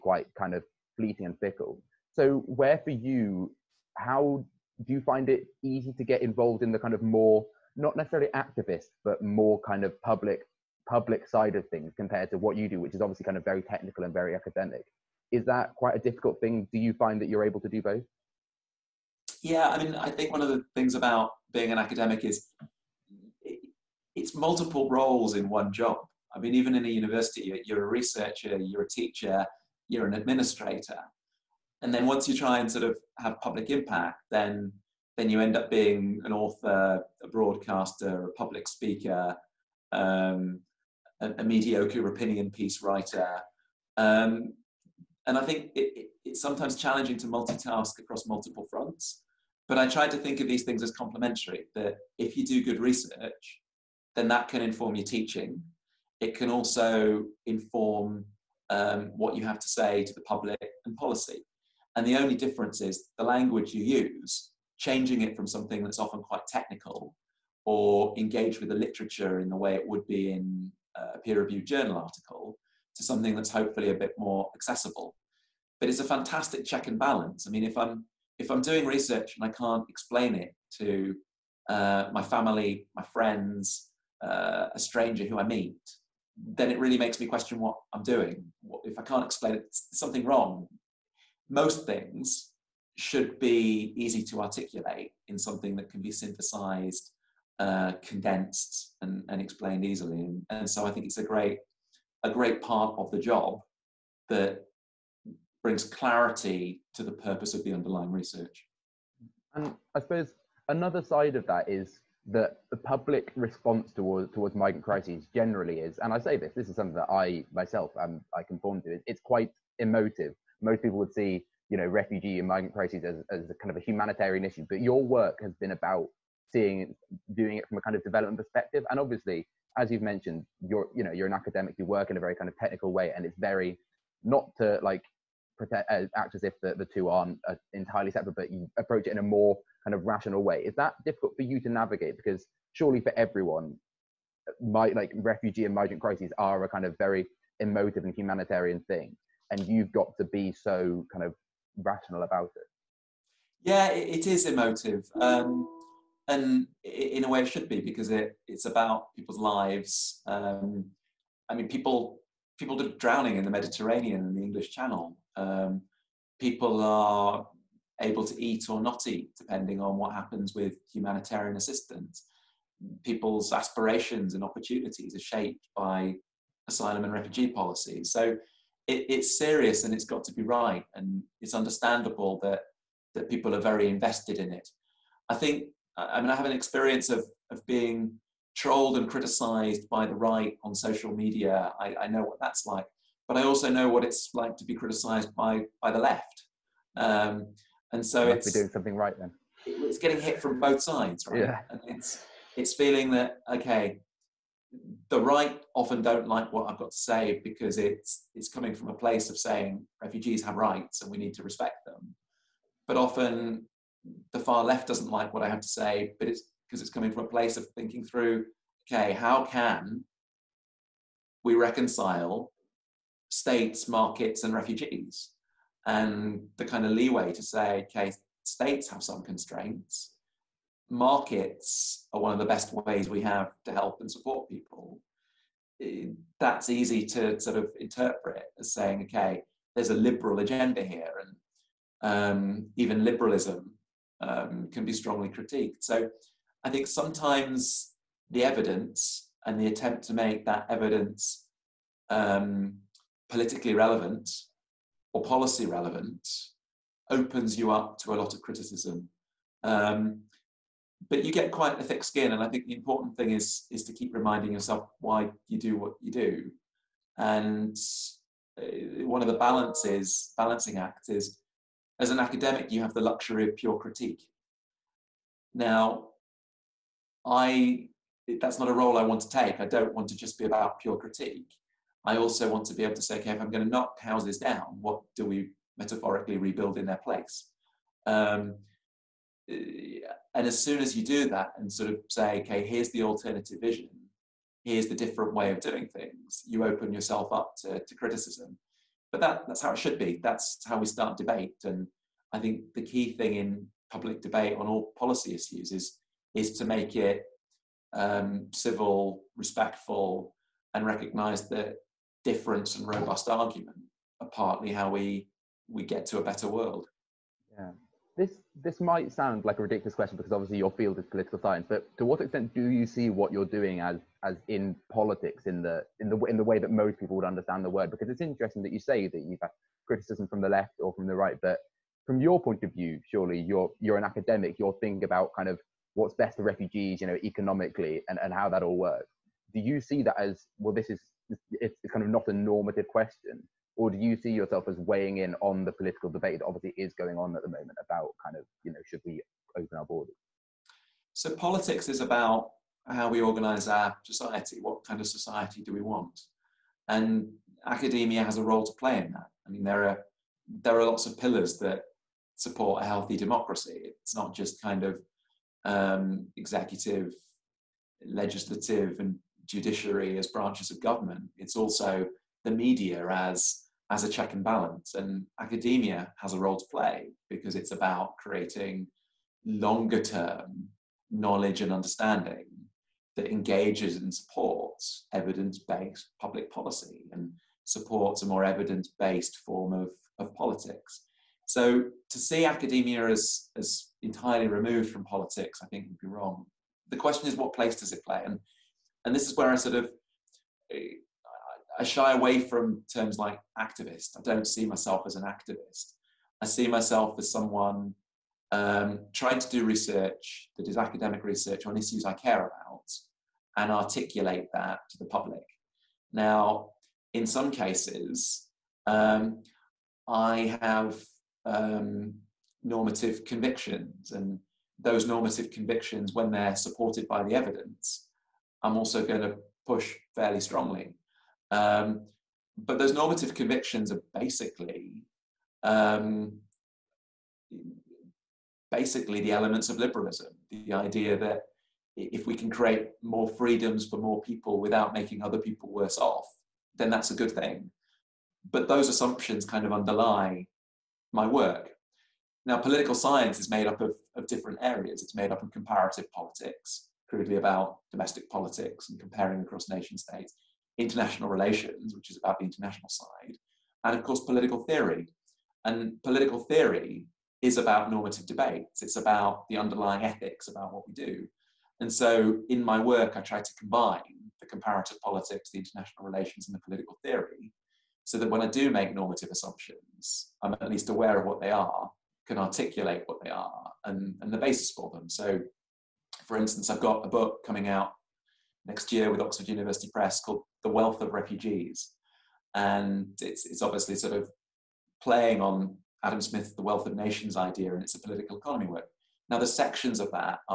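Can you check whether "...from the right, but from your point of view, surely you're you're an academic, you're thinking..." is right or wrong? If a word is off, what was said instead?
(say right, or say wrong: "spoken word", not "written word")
right.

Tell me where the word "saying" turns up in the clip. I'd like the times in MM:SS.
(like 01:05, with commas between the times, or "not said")
03:29, 03:58.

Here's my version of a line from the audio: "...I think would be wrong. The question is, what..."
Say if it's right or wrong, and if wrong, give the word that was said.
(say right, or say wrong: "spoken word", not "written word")
right.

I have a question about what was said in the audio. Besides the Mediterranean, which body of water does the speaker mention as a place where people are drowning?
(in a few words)
English Channel.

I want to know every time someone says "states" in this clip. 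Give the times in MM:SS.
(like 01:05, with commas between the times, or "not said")
03:43, 03:48, 07:39.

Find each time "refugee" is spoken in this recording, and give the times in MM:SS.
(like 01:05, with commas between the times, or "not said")
02:01, 02:25, 02:57, 03:30, 03:44, 05:36, 08:11.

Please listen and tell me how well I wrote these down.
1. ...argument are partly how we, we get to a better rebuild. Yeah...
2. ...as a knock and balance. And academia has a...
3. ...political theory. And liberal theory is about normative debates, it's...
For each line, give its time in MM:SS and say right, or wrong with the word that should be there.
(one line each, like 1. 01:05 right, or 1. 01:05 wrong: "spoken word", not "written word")
1. 05:13 wrong: "world", not "rebuild"
2. 06:13 wrong: "check", not "knock"
3. 07:44 wrong: "political", not "liberal".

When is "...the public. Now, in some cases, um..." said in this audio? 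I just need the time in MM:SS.
06:54.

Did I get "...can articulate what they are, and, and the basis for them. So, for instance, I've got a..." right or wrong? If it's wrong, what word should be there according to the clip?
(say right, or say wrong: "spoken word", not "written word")
right.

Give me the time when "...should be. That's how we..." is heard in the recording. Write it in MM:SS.
04:59.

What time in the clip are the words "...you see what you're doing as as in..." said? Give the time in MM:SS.
05:22.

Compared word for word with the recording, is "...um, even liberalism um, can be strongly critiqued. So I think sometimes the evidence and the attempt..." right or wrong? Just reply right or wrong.
right.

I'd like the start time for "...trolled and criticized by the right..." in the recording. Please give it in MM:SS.
03:08.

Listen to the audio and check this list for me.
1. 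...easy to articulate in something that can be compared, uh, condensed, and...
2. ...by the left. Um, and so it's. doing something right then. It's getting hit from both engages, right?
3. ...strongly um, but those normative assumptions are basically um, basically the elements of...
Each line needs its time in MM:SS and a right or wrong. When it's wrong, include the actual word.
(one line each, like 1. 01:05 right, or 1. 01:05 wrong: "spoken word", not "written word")
1. 01:33 wrong: "synthesized", not "compared"
2. 03:15 wrong: "sides", not "engages"
3. 07:10 wrong: "convictions", not "assumptions".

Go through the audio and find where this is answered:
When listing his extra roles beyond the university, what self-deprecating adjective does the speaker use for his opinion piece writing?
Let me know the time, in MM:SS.
00:41.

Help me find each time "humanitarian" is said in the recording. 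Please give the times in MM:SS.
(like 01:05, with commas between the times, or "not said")
02:03, 02:28, 02:50.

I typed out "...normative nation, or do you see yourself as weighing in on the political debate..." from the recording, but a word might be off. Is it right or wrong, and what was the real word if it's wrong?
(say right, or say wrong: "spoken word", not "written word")
wrong: "question", not "nation".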